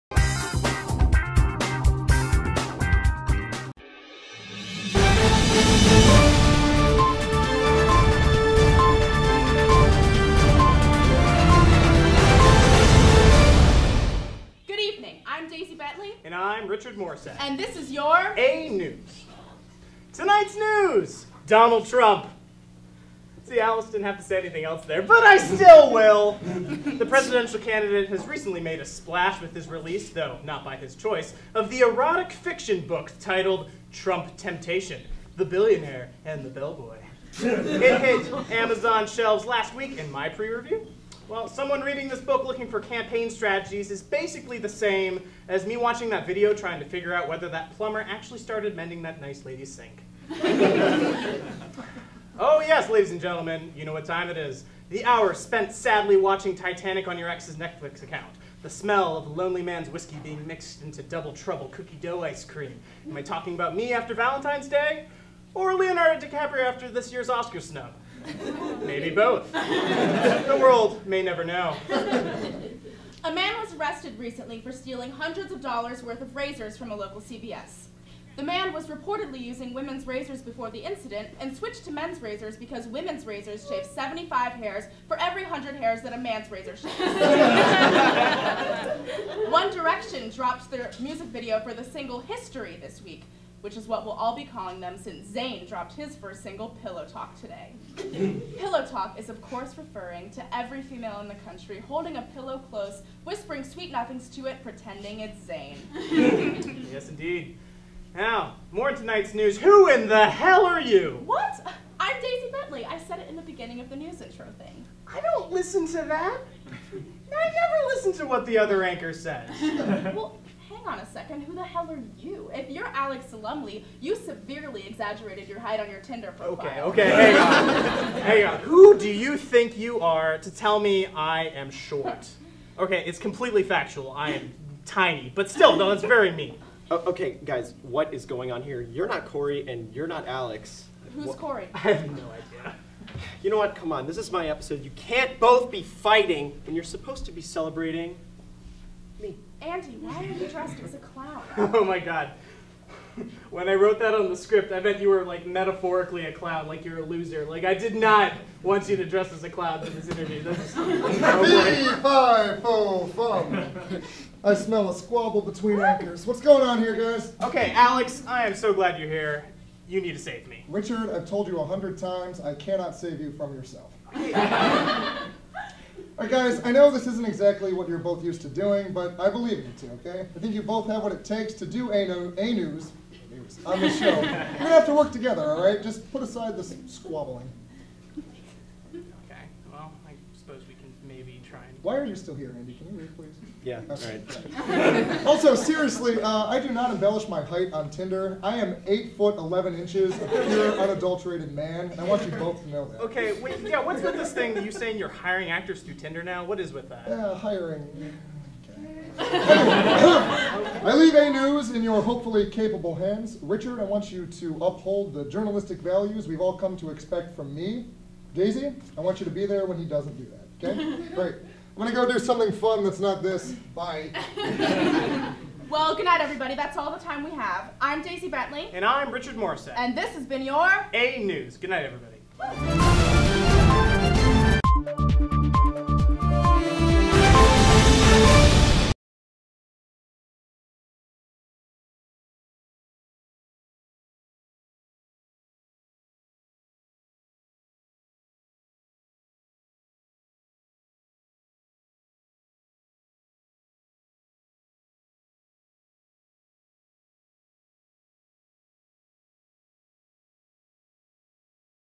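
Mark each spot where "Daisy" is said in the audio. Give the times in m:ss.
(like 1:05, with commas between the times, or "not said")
1:52, 3:38, 3:48.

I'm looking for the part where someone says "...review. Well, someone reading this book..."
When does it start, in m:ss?
0:40.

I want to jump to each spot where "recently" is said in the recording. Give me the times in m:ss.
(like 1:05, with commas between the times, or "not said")
0:28, 1:14.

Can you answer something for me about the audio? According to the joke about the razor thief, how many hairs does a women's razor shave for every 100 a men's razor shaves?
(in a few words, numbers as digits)
75.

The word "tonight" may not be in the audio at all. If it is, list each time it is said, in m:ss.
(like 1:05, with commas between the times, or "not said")
0:20, 1:48.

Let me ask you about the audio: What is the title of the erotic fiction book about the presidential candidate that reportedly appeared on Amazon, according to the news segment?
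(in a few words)
Trump Temptation.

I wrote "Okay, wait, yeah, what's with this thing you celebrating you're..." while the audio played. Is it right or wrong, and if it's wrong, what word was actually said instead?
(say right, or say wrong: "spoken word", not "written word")
wrong: "saying", not "celebrating".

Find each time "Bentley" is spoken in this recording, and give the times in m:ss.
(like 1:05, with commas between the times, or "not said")
1:52, 3:48.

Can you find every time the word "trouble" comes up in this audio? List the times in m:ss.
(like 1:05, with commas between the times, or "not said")
1:01.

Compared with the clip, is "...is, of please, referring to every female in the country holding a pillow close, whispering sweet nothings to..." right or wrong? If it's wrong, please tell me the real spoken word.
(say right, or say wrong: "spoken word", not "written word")
wrong: "course", not "please".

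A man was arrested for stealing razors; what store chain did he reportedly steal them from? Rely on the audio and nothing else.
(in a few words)
CVS.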